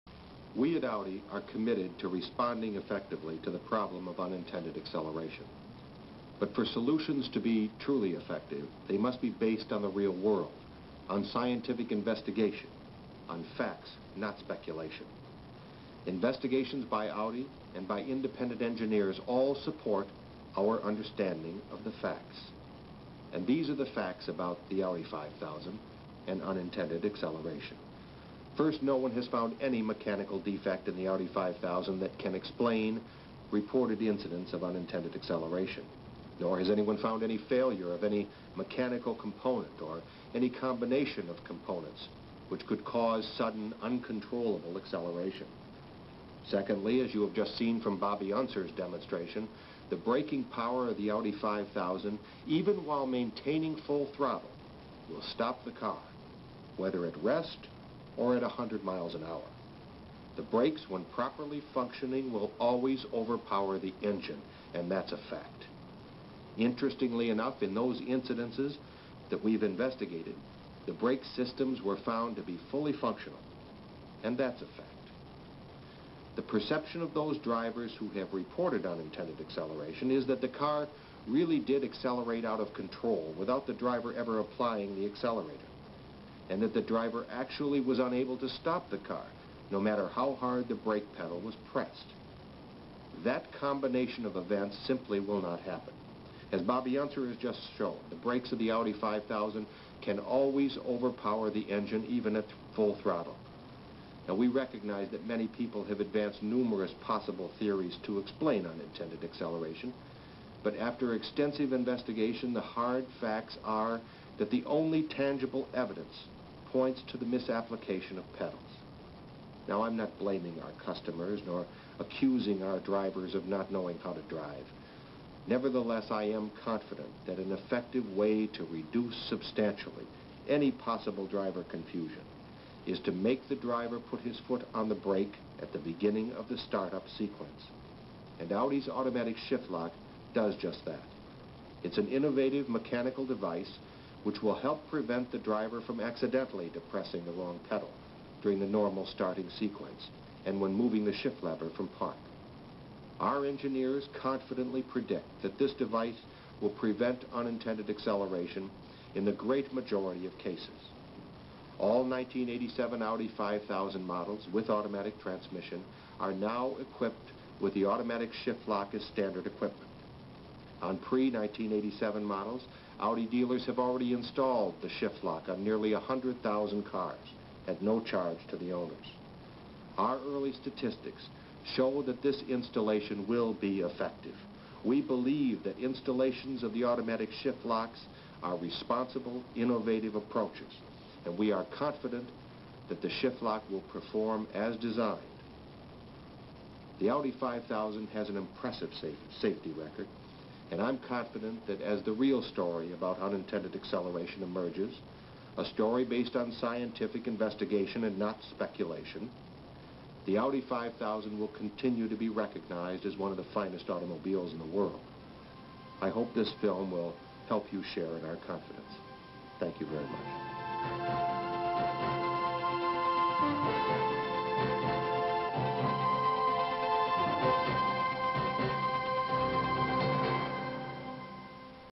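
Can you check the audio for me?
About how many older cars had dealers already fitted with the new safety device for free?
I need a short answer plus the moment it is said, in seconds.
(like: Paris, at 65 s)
nearly 100,000, at 175 s.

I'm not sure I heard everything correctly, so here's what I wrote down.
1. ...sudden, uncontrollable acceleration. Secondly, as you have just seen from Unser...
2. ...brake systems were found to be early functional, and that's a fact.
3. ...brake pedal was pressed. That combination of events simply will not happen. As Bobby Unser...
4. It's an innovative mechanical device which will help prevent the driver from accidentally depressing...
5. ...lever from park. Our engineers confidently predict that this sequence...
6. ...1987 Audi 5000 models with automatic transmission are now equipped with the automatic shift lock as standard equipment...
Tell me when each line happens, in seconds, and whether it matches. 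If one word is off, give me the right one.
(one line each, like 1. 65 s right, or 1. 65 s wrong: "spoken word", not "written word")
1. 43 s wrong: "Bobby", not "Unser"
2. 70 s wrong: "fully", not "early"
3. 90 s right
4. 141 s right
5. 151 s wrong: "device", not "sequence"
6. 162 s right.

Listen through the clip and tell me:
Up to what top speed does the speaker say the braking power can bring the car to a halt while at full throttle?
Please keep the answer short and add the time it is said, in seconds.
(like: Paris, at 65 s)
100 miles an hour, at 58 s.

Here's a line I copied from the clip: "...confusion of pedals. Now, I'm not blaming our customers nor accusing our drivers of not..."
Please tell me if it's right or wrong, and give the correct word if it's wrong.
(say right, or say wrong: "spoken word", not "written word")
wrong: "misapplication", not "confusion".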